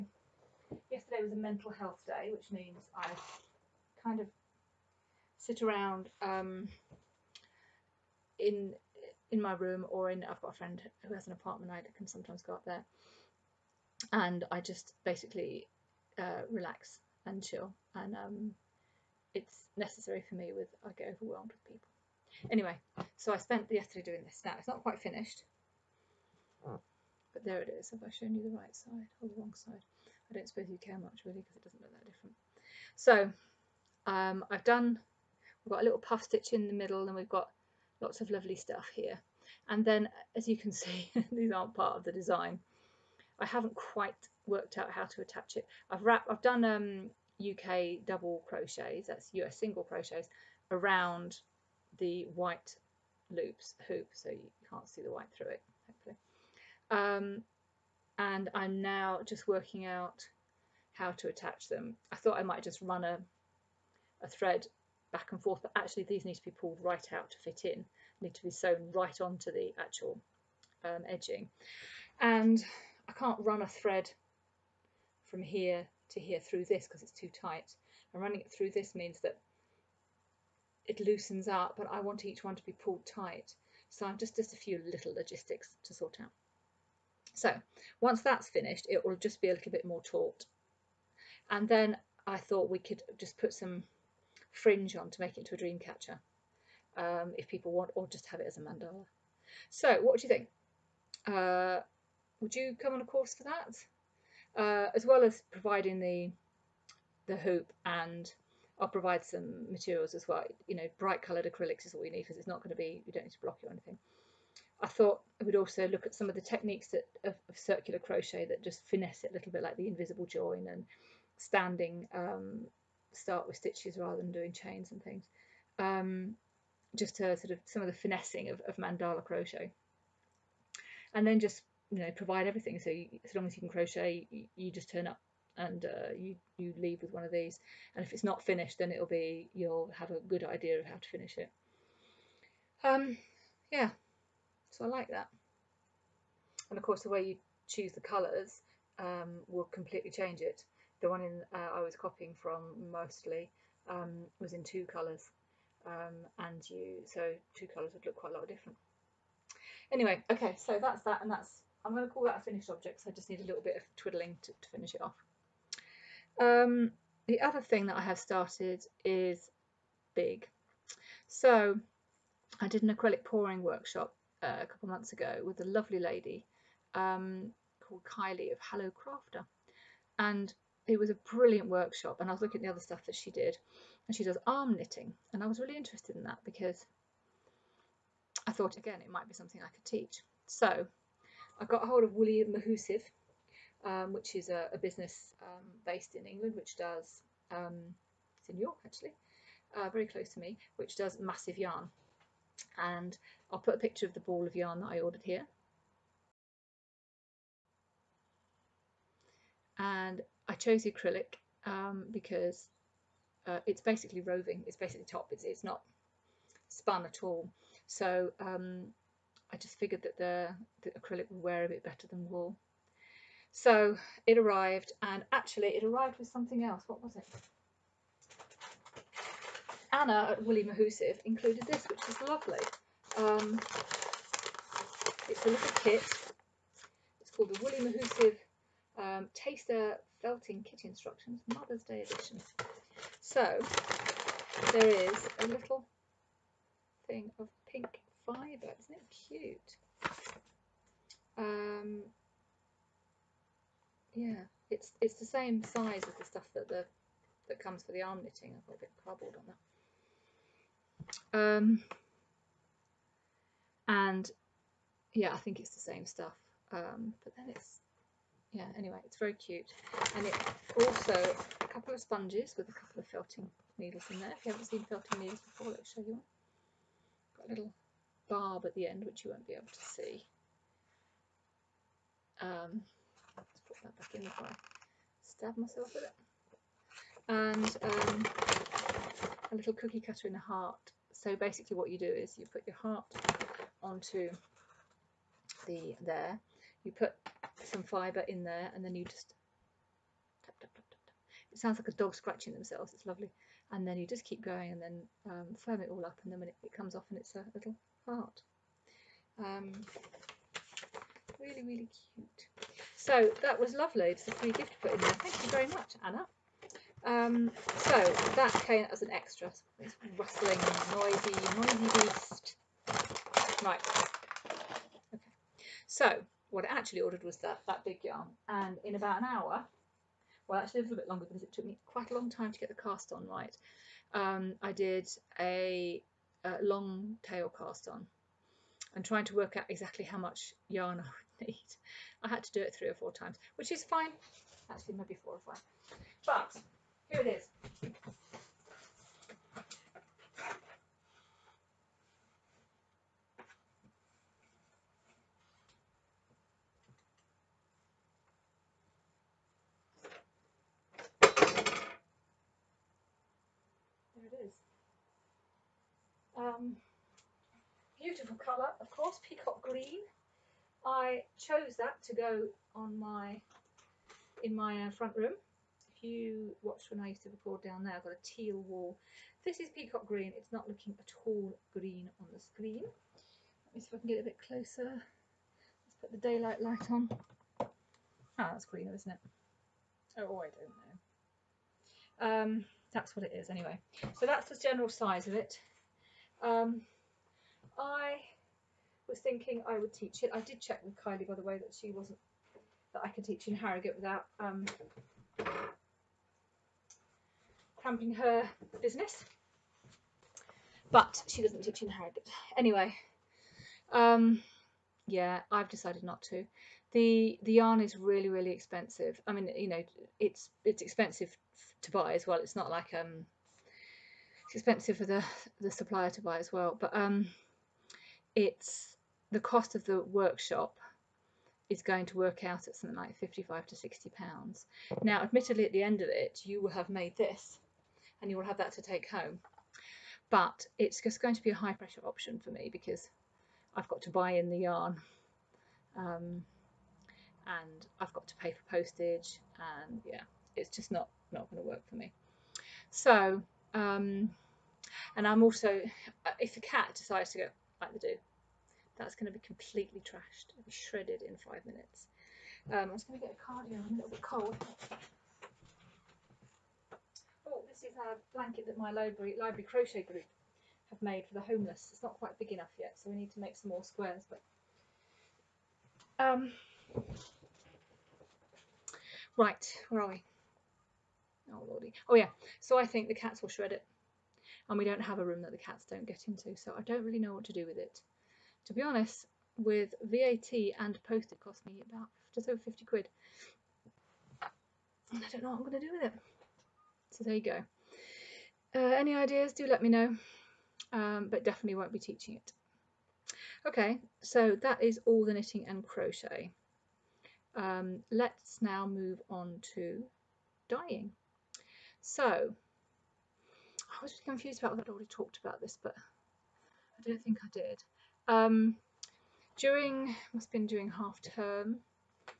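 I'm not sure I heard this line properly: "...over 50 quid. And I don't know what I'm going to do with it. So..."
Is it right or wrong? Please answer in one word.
right.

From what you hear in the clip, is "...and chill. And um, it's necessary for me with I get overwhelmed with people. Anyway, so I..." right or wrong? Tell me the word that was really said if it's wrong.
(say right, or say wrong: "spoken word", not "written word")
right.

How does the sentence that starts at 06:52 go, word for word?
Anyway, um, yeah, I've decided not to.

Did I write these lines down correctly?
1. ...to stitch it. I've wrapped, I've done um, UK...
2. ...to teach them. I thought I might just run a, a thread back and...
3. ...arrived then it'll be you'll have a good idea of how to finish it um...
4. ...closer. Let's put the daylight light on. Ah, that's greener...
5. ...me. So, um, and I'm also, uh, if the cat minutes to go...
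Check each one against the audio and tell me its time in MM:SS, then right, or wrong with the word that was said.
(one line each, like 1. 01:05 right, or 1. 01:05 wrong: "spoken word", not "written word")
1. 00:45 wrong: "attach", not "stitch"
2. 01:01 wrong: "attach", not "teach"
3. 02:18 wrong: "finished", not "arrived"
4. 06:24 right
5. 07:31 wrong: "decides", not "minutes".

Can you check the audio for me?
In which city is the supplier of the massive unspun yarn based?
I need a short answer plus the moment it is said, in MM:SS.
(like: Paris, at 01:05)
York, at 03:18.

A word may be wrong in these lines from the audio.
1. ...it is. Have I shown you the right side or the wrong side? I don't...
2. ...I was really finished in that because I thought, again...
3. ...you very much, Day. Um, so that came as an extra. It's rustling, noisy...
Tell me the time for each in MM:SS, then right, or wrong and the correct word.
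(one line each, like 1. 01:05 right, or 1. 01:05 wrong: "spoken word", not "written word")
1. 00:27 right
2. 03:05 wrong: "interested", not "finished"
3. 05:15 wrong: "Anna", not "Day".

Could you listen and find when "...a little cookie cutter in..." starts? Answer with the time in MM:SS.
04:49.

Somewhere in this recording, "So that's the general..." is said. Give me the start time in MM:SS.
06:34.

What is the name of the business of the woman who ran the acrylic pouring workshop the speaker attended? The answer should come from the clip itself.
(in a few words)
Hello Crafter.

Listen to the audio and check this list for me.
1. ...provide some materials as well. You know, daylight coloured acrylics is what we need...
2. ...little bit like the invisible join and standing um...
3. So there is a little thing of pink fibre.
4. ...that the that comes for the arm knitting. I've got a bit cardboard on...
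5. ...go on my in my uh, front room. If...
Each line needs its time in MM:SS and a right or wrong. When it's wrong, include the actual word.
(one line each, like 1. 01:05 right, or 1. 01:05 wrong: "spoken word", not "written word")
1. 01:48 wrong: "bright", not "daylight"
2. 01:59 right
3. 04:03 right
4. 04:16 right
5. 06:12 right.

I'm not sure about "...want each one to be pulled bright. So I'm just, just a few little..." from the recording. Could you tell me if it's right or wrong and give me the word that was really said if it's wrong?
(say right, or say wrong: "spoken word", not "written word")
wrong: "tight", not "bright".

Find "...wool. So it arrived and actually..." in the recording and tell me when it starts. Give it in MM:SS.
03:42.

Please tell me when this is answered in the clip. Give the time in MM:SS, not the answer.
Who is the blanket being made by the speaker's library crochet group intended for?
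07:51.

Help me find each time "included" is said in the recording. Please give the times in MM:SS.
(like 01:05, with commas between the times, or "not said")
03:51.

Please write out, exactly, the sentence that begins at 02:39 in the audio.
Anyway, okay, so that's that, and that's I'm going to call that a finished object.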